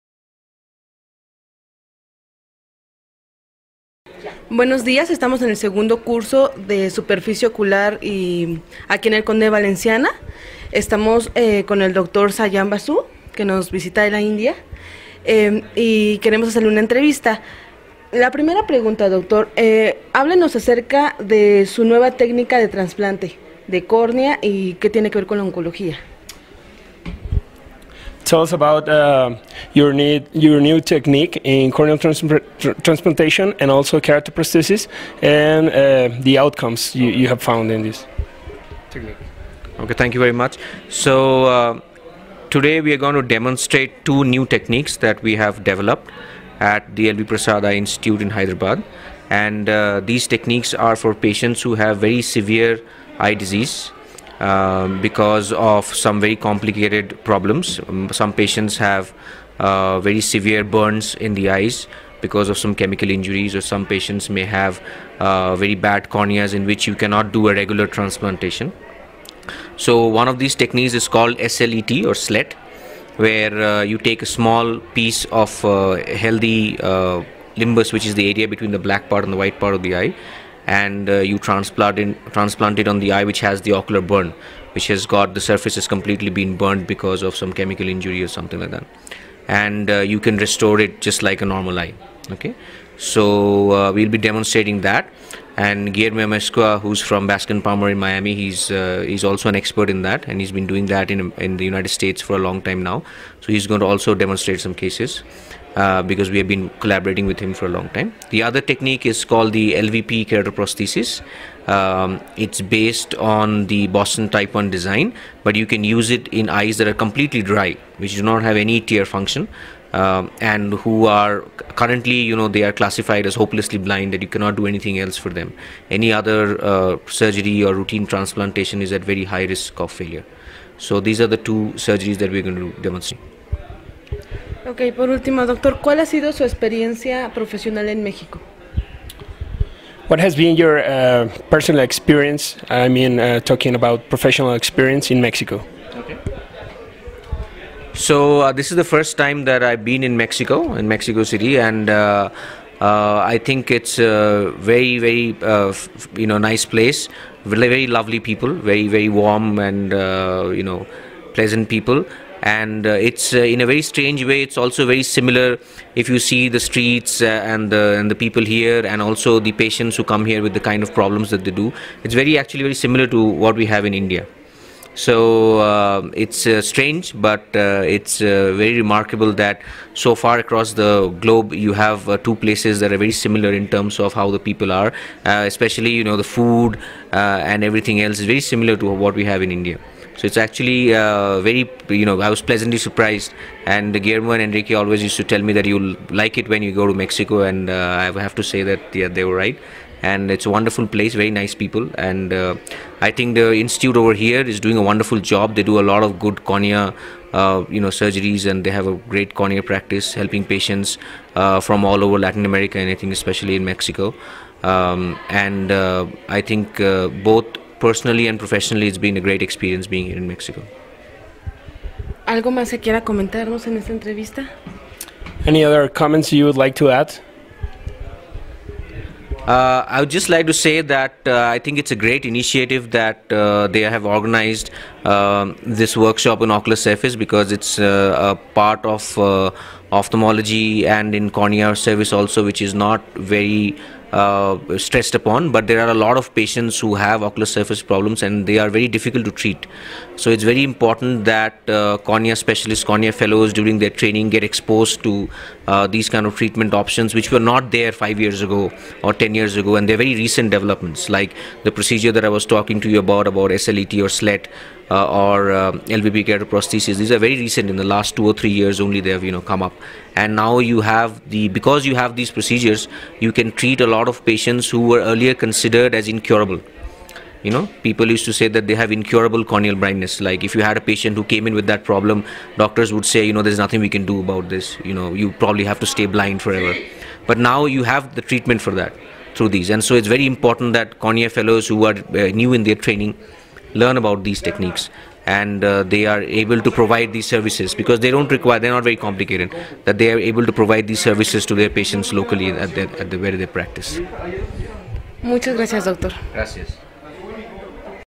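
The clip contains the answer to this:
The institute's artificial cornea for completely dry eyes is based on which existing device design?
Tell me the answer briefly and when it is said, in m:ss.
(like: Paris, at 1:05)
Boston Type 1, at 1:53.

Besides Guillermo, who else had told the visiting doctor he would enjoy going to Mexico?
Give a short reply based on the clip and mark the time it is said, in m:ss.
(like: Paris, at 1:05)
Enrique, at 3:14.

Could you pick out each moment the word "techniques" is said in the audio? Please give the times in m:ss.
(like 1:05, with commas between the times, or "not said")
0:30, 0:38, 0:44, 0:50, 1:10, 1:48, 4:54.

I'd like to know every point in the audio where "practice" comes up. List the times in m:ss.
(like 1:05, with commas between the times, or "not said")
3:29, 5:03.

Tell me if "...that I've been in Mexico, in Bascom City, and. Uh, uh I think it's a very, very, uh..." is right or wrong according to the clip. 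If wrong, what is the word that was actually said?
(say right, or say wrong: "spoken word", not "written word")
wrong: "Mexico", not "Bascom".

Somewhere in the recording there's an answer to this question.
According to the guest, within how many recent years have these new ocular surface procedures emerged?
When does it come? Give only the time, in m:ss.
4:28.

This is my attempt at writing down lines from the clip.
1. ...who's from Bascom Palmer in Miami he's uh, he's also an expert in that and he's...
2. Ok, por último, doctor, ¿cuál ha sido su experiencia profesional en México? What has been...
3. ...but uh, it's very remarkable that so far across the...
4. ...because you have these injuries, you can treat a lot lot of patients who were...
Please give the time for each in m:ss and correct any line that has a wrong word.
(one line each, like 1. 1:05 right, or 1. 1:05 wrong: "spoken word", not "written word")
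1. 1:36 right
2. 2:14 right
3. 2:57 right
4. 4:31 wrong: "procedures", not "injuries".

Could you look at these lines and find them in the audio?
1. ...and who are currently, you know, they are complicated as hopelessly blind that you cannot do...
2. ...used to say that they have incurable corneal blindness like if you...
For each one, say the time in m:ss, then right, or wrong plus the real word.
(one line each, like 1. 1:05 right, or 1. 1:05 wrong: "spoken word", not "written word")
1. 2:00 wrong: "classified", not "complicated"
2. 4:38 right.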